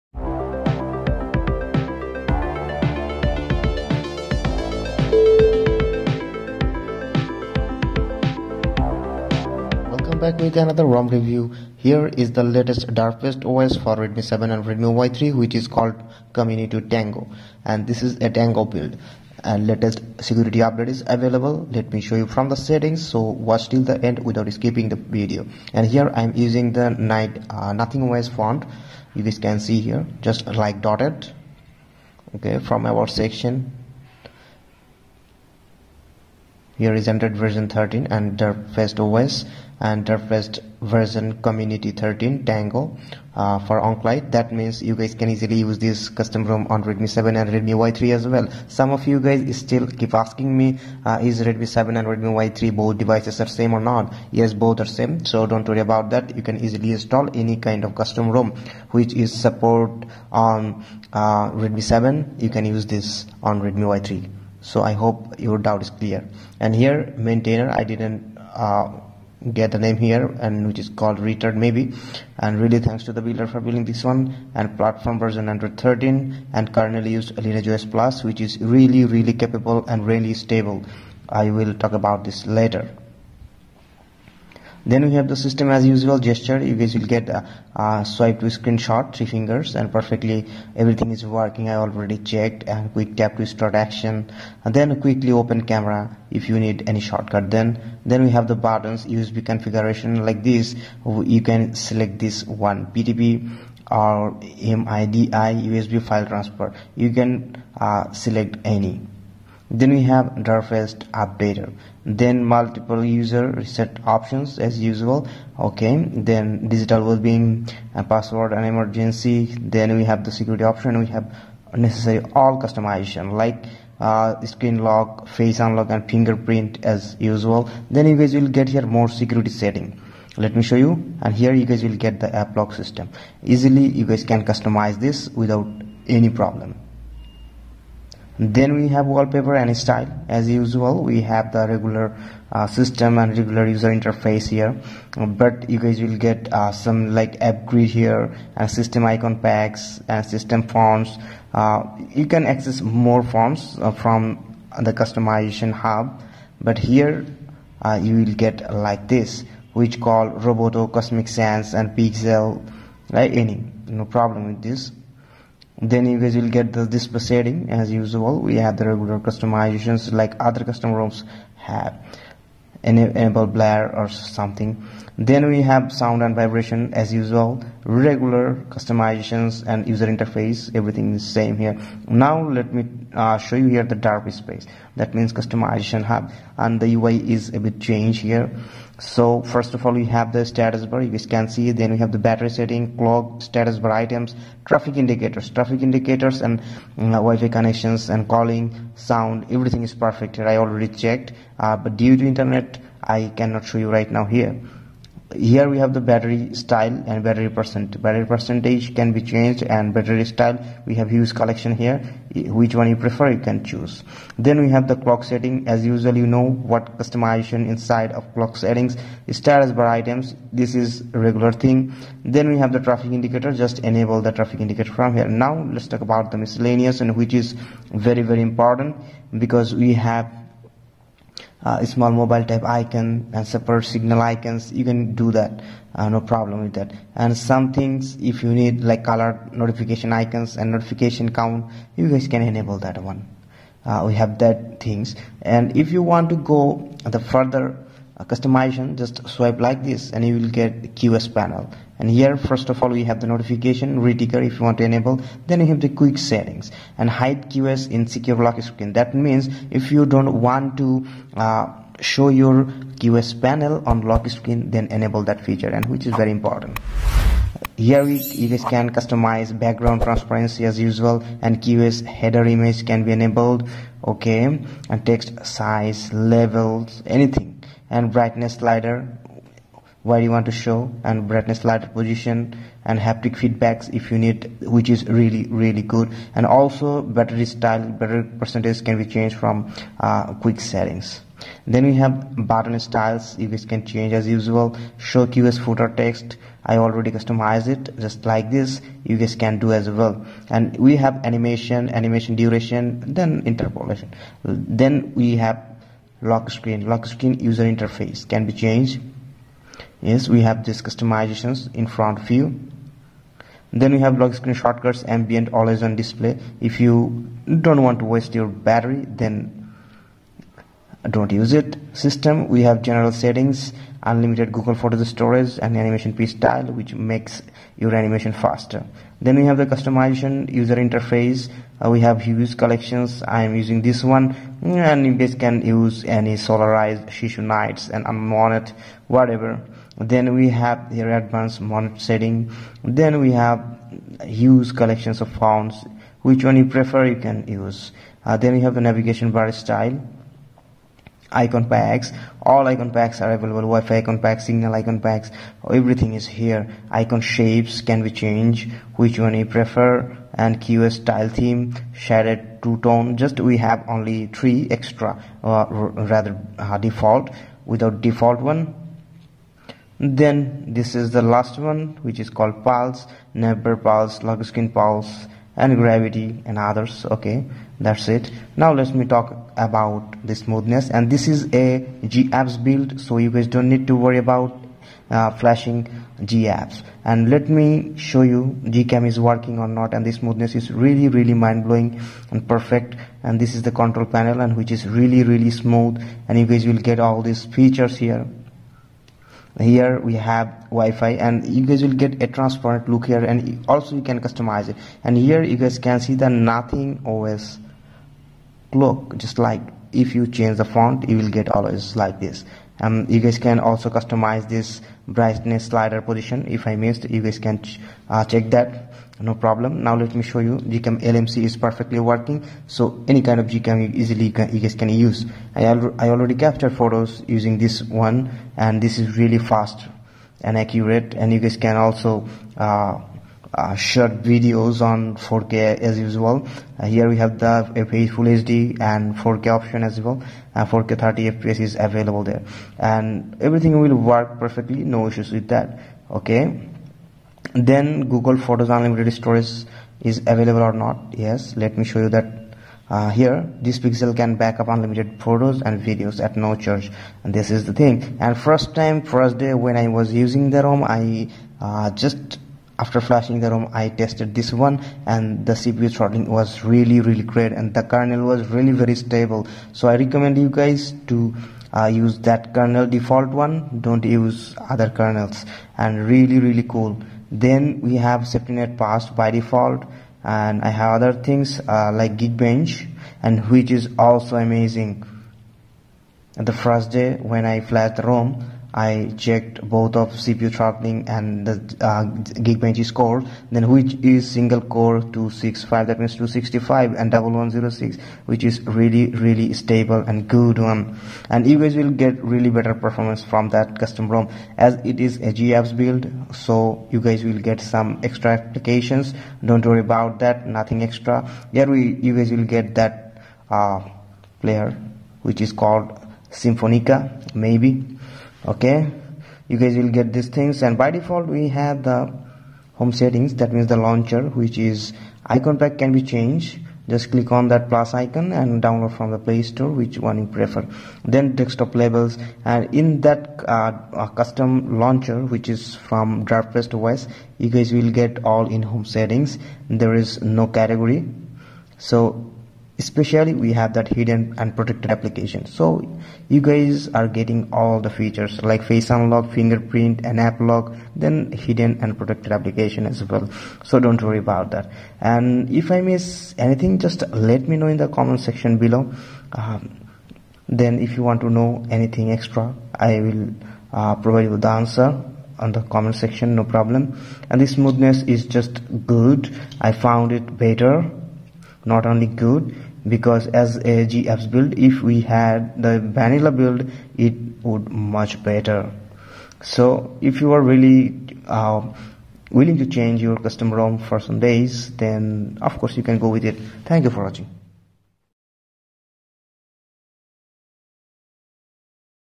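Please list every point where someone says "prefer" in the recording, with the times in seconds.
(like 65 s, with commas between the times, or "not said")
212 s, 346 s, 359 s, 530 s.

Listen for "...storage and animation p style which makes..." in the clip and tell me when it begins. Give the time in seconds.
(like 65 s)
325 s.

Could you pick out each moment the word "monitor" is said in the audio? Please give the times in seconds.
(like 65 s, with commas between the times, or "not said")
341 s.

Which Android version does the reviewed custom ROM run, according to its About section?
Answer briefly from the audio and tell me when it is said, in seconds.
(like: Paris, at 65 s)
13, at 37 s.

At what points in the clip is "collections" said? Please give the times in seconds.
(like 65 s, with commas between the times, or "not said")
211 s, 332 s, 344 s.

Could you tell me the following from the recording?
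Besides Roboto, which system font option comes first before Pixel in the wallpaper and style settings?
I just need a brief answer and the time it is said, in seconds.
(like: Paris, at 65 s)
Comic Sans, at 160 s.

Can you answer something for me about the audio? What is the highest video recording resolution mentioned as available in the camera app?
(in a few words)
4K.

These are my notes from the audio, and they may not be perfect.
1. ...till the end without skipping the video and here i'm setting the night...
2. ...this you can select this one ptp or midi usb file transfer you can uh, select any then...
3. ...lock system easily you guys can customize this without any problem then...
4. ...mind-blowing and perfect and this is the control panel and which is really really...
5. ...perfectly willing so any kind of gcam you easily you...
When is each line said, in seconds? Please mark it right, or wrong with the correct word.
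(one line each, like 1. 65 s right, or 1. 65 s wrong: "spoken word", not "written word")
1. 23 s wrong: "using", not "setting"
2. 100 s right
3. 132 s right
4. 391 s right
5. 421 s wrong: "working", not "willing".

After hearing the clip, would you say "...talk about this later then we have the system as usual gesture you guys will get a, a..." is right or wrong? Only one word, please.
right.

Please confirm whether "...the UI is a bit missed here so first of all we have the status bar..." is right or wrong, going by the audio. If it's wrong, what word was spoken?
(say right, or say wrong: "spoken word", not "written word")
wrong: "changed", not "missed".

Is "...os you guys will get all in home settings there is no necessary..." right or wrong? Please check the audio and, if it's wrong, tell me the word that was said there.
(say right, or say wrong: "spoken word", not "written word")
wrong: "category", not "necessary".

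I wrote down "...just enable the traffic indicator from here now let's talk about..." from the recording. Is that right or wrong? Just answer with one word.
right.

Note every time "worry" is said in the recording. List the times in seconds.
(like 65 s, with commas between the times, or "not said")
55 s, 383 s, 509 s, 554 s.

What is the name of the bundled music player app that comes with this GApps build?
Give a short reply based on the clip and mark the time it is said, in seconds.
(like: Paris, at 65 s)
Symphonica, at 516 s.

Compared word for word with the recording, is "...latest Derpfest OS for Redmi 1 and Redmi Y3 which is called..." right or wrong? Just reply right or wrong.
wrong.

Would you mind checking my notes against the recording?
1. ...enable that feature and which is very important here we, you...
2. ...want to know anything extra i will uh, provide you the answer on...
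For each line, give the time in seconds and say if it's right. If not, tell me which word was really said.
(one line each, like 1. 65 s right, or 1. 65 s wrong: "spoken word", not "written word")
1. 264 s right
2. 561 s right.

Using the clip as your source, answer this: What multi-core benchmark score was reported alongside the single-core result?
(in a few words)
1106.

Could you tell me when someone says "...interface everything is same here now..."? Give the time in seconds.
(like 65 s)
180 s.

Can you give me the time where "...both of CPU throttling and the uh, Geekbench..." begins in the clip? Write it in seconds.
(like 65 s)
489 s.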